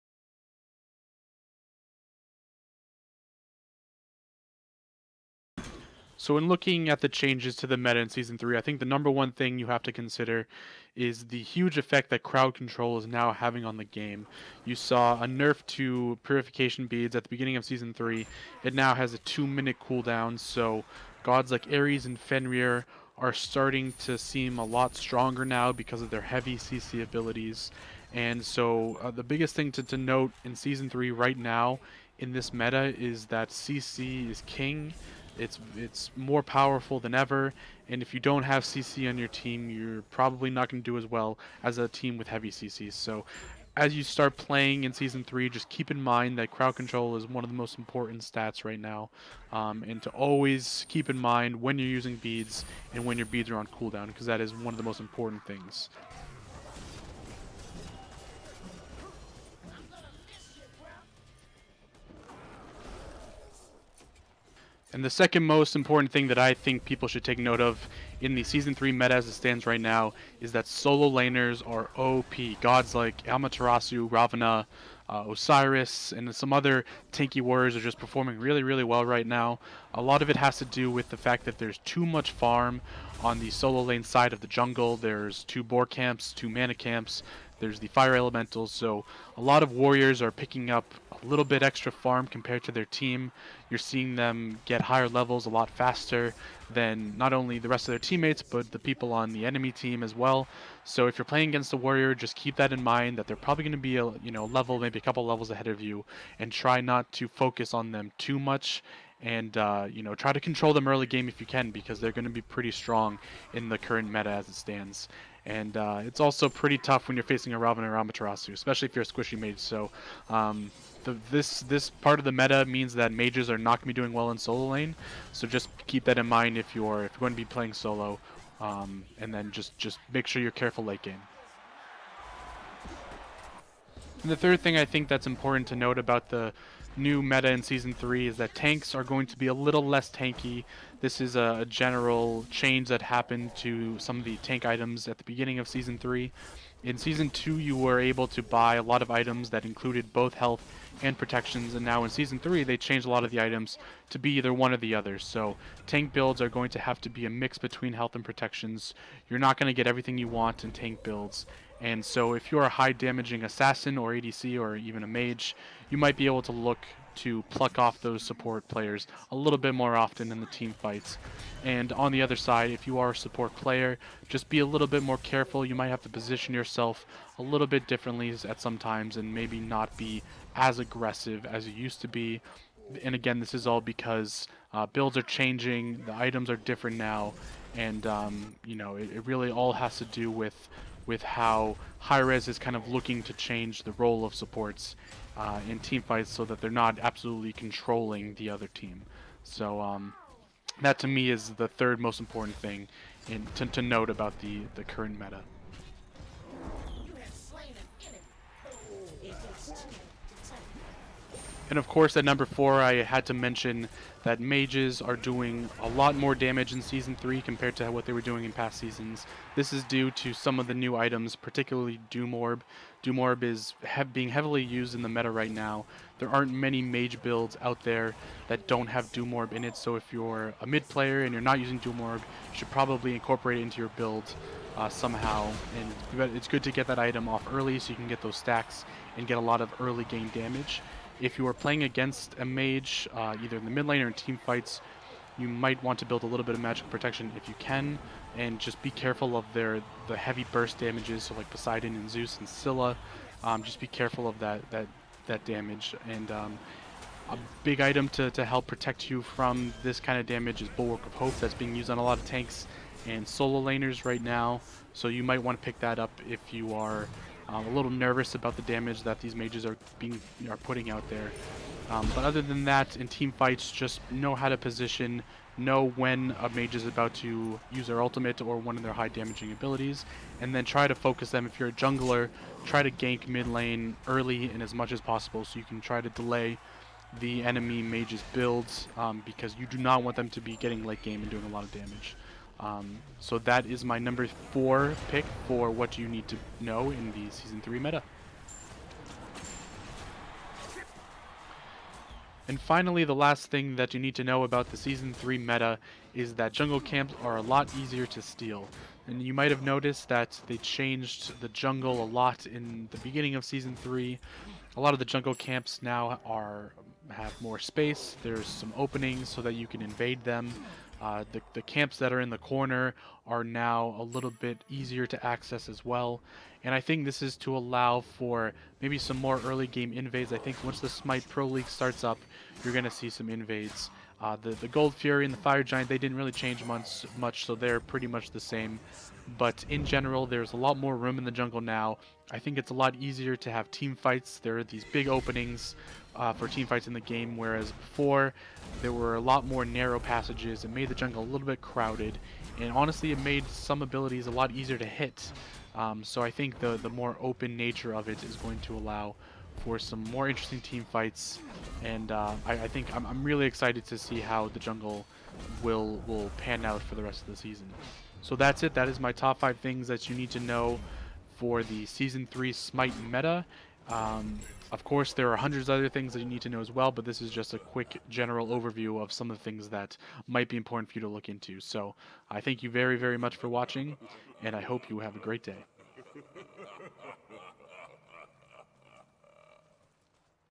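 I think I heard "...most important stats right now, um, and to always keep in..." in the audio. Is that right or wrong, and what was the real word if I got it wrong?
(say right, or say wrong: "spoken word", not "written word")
right.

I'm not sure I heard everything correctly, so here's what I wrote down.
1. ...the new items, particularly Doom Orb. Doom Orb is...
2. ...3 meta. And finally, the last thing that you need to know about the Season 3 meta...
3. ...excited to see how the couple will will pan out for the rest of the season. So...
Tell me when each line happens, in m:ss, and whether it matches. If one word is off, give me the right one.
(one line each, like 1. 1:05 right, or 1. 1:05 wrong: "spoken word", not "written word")
1. 3:40 right
2. 4:57 right
3. 6:03 wrong: "jungle", not "couple".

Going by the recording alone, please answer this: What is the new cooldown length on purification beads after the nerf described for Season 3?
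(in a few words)
2 minutes.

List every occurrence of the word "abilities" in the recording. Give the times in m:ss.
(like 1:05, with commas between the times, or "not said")
0:27, 4:39, 5:53.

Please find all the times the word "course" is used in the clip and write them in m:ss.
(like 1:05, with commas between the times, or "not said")
3:31, 6:14.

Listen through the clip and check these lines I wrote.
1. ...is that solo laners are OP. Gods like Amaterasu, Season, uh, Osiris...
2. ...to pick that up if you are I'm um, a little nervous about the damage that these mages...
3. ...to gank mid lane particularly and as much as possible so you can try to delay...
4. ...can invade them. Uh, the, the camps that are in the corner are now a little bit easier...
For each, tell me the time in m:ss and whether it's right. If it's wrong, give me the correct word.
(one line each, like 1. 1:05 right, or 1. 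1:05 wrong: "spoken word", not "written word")
1. 1:10 wrong: "Ravana", not "Season"
2. 4:25 right
3. 4:42 wrong: "early", not "particularly"
4. 5:19 right.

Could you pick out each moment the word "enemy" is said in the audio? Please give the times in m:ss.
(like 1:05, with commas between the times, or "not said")
1:39, 4:47.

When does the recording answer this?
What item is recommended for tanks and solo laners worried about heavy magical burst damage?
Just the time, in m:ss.
4:20.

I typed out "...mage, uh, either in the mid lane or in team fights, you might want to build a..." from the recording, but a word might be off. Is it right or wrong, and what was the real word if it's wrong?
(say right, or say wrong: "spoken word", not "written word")
right.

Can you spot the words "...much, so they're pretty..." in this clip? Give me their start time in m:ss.
5:37.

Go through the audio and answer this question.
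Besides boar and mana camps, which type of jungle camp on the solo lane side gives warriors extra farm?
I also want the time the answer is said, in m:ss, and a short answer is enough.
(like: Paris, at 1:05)
fire elementals, at 1:27.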